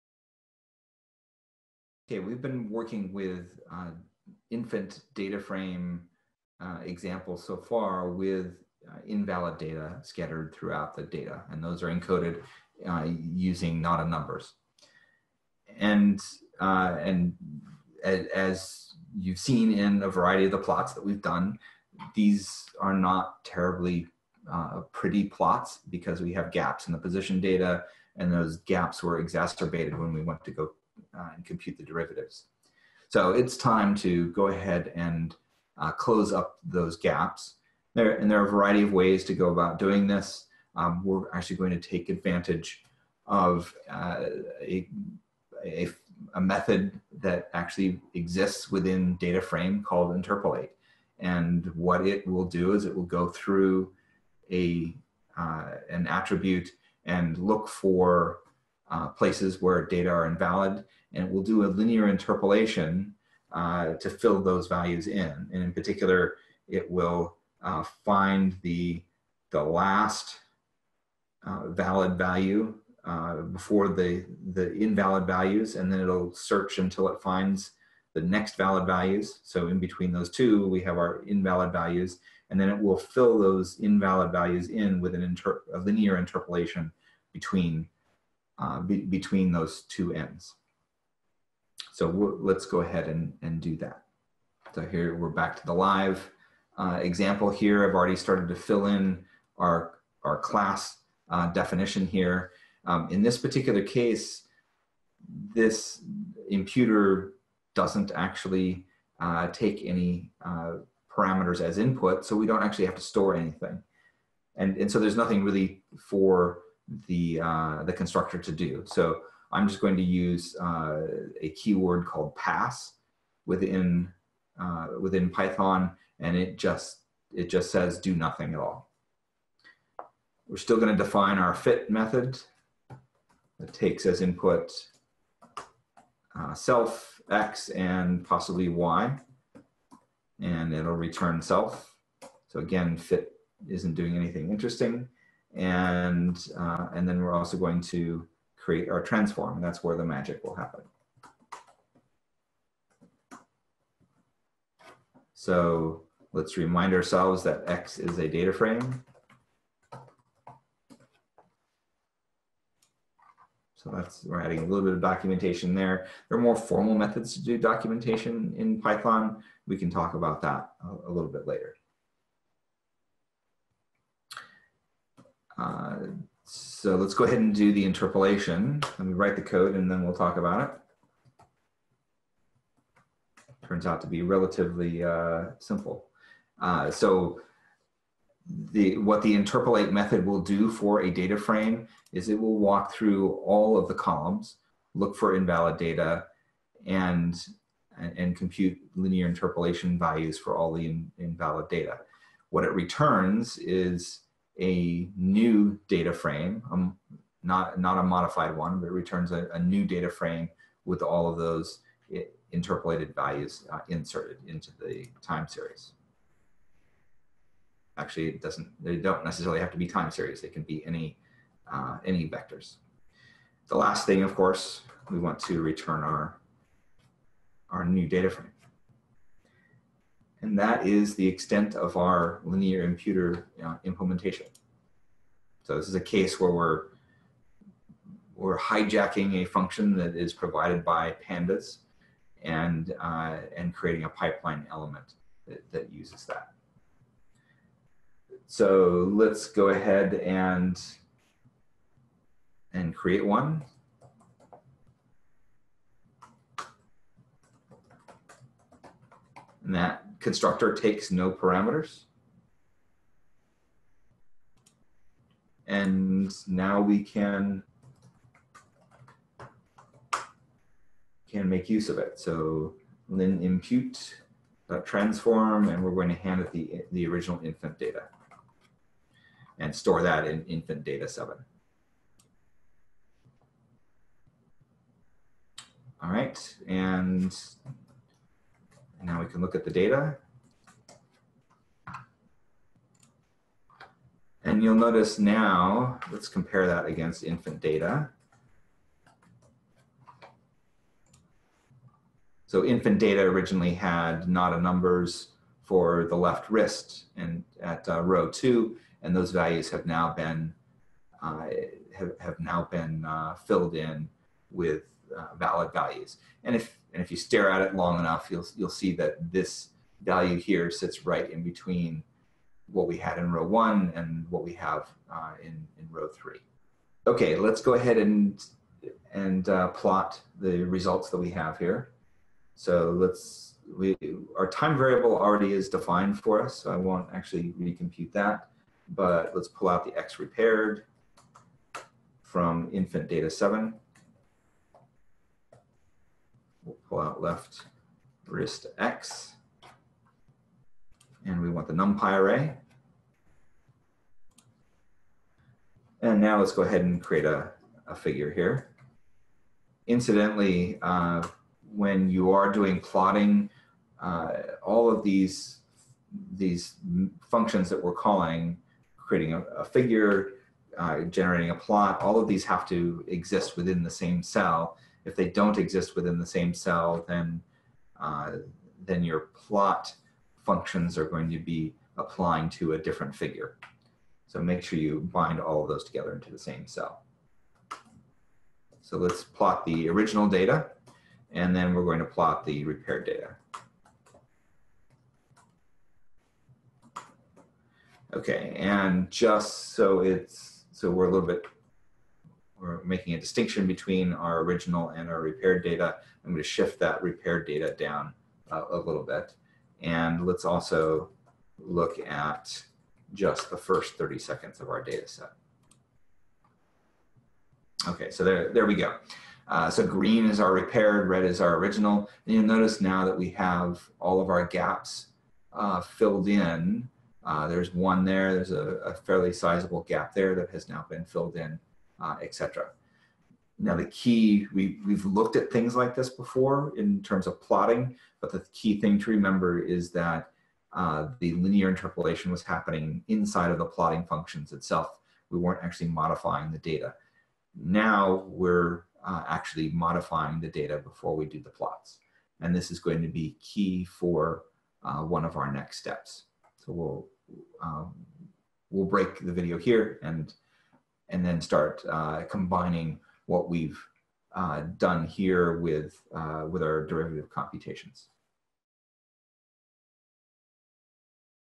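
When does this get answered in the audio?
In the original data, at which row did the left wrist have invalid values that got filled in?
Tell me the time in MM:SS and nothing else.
05:08.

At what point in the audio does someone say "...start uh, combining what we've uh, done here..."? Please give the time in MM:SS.
07:41.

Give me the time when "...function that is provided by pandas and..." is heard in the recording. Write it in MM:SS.
03:59.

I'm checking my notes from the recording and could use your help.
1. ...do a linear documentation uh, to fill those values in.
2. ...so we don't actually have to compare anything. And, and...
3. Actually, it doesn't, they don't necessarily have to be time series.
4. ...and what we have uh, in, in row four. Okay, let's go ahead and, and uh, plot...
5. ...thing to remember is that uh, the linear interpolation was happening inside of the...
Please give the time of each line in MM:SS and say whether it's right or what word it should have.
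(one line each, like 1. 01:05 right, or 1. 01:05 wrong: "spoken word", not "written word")
1. 01:01 wrong: "interpolation", not "documentation"
2. 01:52 wrong: "store", not "compare"
3. 03:37 right
4. 05:23 wrong: "three", not "four"
5. 07:18 right.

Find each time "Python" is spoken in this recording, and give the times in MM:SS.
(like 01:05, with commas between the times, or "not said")
02:05, 02:48.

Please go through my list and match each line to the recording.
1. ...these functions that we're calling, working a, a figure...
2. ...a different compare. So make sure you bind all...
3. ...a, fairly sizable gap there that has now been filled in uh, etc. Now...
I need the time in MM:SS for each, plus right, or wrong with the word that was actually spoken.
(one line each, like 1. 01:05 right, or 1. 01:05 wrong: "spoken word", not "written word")
1. 06:06 wrong: "creating", not "working"
2. 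06:22 wrong: "figure", not "compare"
3. 07:08 right.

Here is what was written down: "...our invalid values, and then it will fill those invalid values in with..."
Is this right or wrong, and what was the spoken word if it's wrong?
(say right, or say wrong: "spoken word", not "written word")
right.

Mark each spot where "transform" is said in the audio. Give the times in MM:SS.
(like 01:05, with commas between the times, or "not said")
02:29, 04:34.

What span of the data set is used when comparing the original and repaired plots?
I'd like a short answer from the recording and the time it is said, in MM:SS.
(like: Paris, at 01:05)
First 30 seconds, at 06:53.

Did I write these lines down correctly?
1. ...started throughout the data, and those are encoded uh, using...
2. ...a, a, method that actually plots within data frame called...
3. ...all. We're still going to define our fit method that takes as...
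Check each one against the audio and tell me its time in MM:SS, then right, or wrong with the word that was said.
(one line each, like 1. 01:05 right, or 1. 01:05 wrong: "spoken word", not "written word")
1. 00:10 wrong: "scattered", not "started"
2. 00:45 wrong: "exists", not "plots"
3. 02:08 right.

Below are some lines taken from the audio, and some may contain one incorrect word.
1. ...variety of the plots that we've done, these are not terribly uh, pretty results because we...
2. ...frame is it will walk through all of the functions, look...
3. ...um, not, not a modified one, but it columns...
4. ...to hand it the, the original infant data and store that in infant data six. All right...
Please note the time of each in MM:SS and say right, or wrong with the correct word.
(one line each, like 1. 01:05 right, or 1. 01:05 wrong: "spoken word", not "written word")
1. 00:20 wrong: "plots", not "results"
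2. 03:11 wrong: "columns", not "functions"
3. 03:26 wrong: "returns", not "columns"
4. 04:36 wrong: "seven", not "six".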